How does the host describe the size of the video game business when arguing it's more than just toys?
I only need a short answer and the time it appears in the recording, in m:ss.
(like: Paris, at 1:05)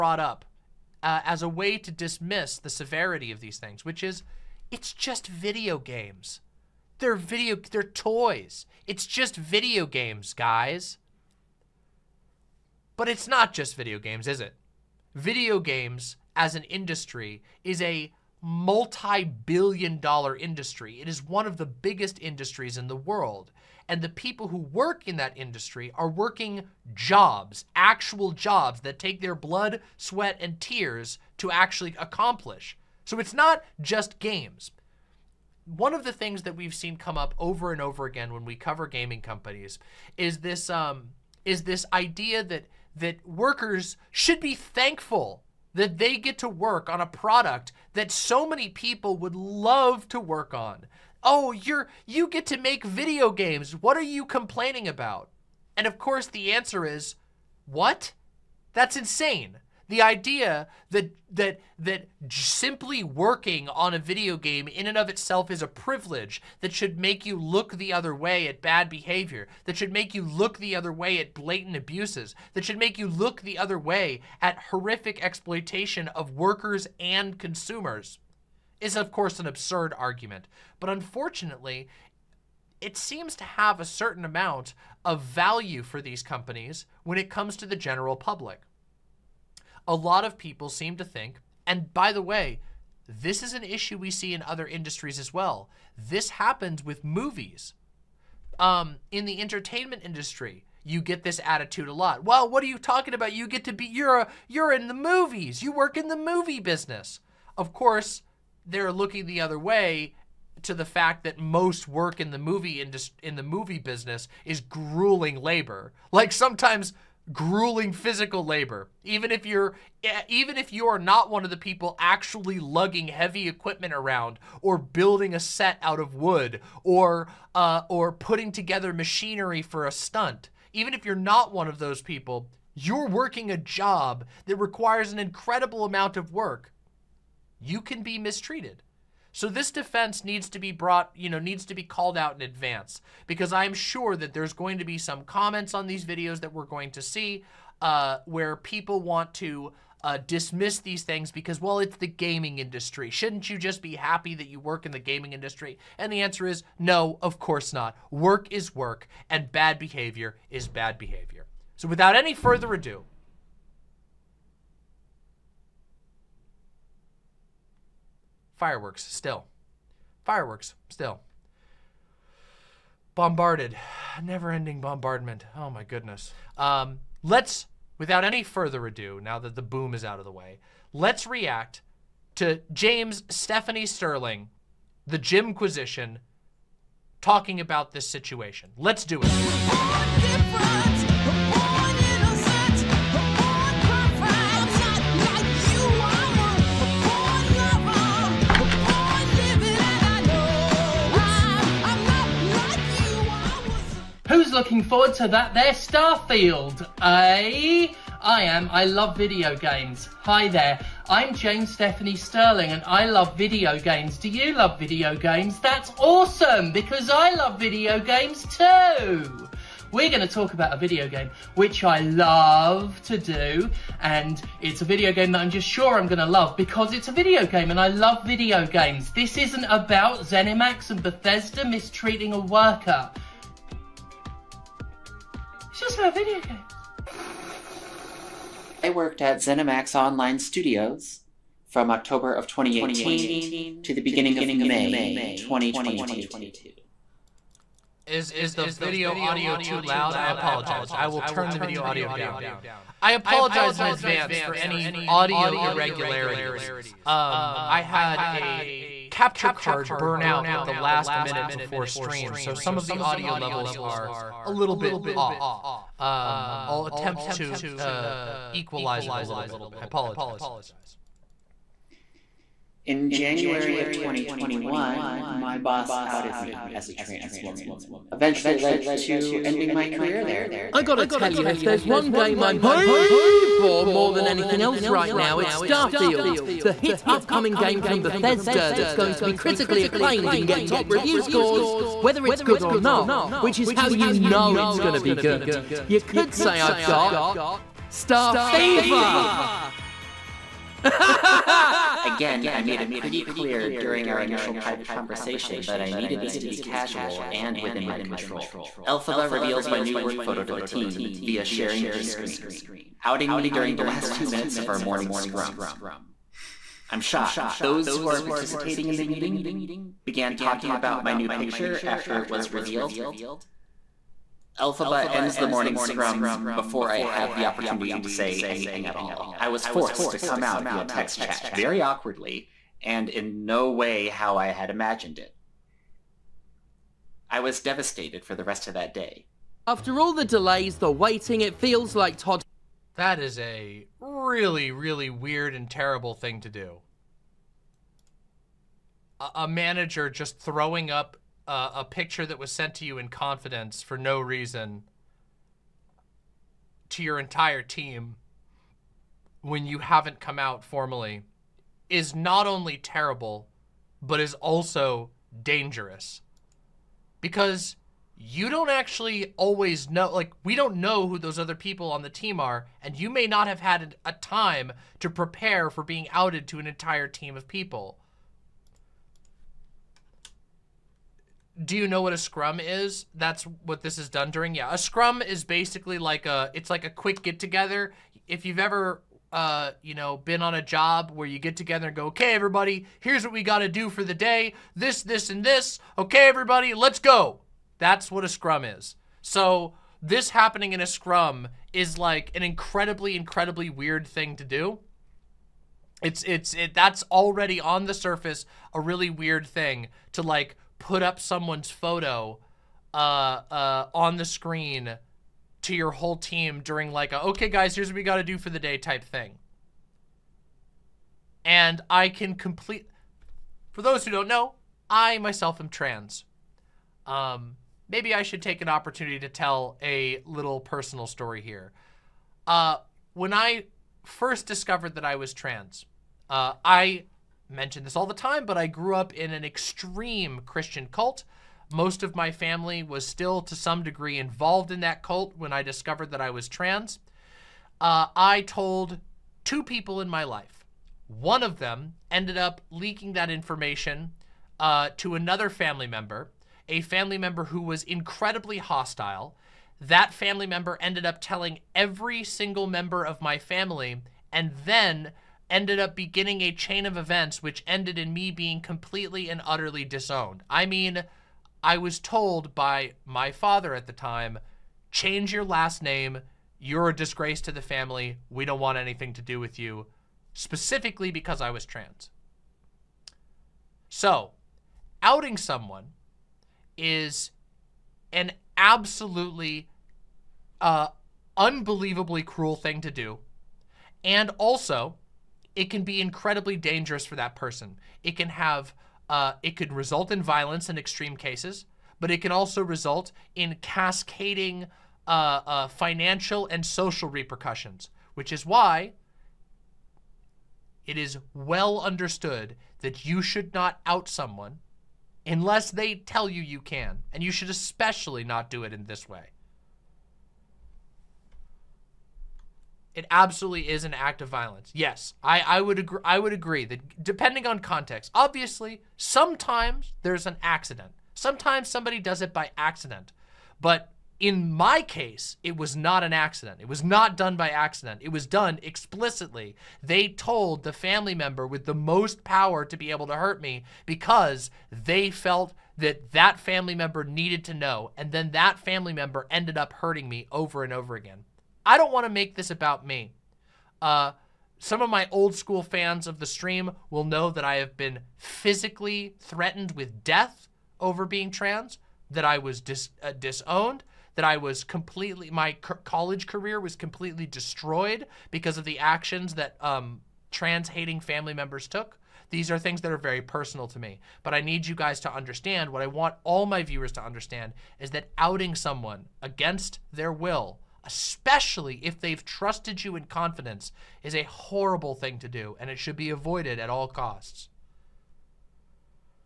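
multi-billion dollar, at 0:18.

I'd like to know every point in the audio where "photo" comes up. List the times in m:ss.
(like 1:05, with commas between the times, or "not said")
5:10, 6:51.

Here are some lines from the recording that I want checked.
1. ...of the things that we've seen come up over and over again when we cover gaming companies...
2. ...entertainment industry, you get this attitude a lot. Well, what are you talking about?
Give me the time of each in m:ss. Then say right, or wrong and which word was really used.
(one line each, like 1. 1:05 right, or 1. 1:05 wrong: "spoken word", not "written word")
1. 0:35 right
2. 1:39 right.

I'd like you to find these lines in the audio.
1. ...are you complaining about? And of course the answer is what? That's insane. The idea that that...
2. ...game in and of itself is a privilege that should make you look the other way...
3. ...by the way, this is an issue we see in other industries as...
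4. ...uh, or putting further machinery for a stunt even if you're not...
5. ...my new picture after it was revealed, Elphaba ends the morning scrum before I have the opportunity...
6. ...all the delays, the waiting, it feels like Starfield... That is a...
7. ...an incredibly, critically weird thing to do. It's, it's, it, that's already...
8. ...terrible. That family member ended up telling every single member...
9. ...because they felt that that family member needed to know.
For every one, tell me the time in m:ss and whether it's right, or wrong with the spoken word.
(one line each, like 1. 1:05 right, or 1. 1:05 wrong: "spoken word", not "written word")
1. 0:53 right
2. 1:04 right
3. 1:31 right
4. 2:07 wrong: "together", not "further"
5. 5:21 right
6. 5:39 wrong: "Todd", not "Starfield"
7. 6:42 wrong: "incredibly", not "critically"
8. 7:38 wrong: "hostile", not "terrible"
9. 9:03 right.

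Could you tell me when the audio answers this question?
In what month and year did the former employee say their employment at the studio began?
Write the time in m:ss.
4:01.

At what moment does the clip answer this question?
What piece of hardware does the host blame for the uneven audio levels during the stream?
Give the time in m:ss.
4:19.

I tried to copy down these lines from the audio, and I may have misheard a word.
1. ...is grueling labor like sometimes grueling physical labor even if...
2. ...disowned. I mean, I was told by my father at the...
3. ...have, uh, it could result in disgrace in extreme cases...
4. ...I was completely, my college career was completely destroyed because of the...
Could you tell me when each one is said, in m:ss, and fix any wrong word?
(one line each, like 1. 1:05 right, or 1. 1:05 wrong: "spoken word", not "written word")
1. 1:54 right
2. 7:49 right
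3. 8:18 wrong: "violence", not "disgrace"
4. 9:24 right.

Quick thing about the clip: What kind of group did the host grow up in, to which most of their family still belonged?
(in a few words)
extreme Christian cult.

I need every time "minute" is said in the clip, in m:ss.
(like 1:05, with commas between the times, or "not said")
4:21, 5:14.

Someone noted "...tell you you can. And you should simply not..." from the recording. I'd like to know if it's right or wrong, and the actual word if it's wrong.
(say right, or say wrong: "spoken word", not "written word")
wrong: "especially", not "simply".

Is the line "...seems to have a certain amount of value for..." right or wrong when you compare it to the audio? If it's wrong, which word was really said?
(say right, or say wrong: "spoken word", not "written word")
right.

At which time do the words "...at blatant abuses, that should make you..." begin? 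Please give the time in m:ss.
1:11.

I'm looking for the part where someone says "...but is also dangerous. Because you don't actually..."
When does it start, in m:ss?
6:04.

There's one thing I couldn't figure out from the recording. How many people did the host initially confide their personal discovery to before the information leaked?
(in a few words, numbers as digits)
2.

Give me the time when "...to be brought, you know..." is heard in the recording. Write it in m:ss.
2:20.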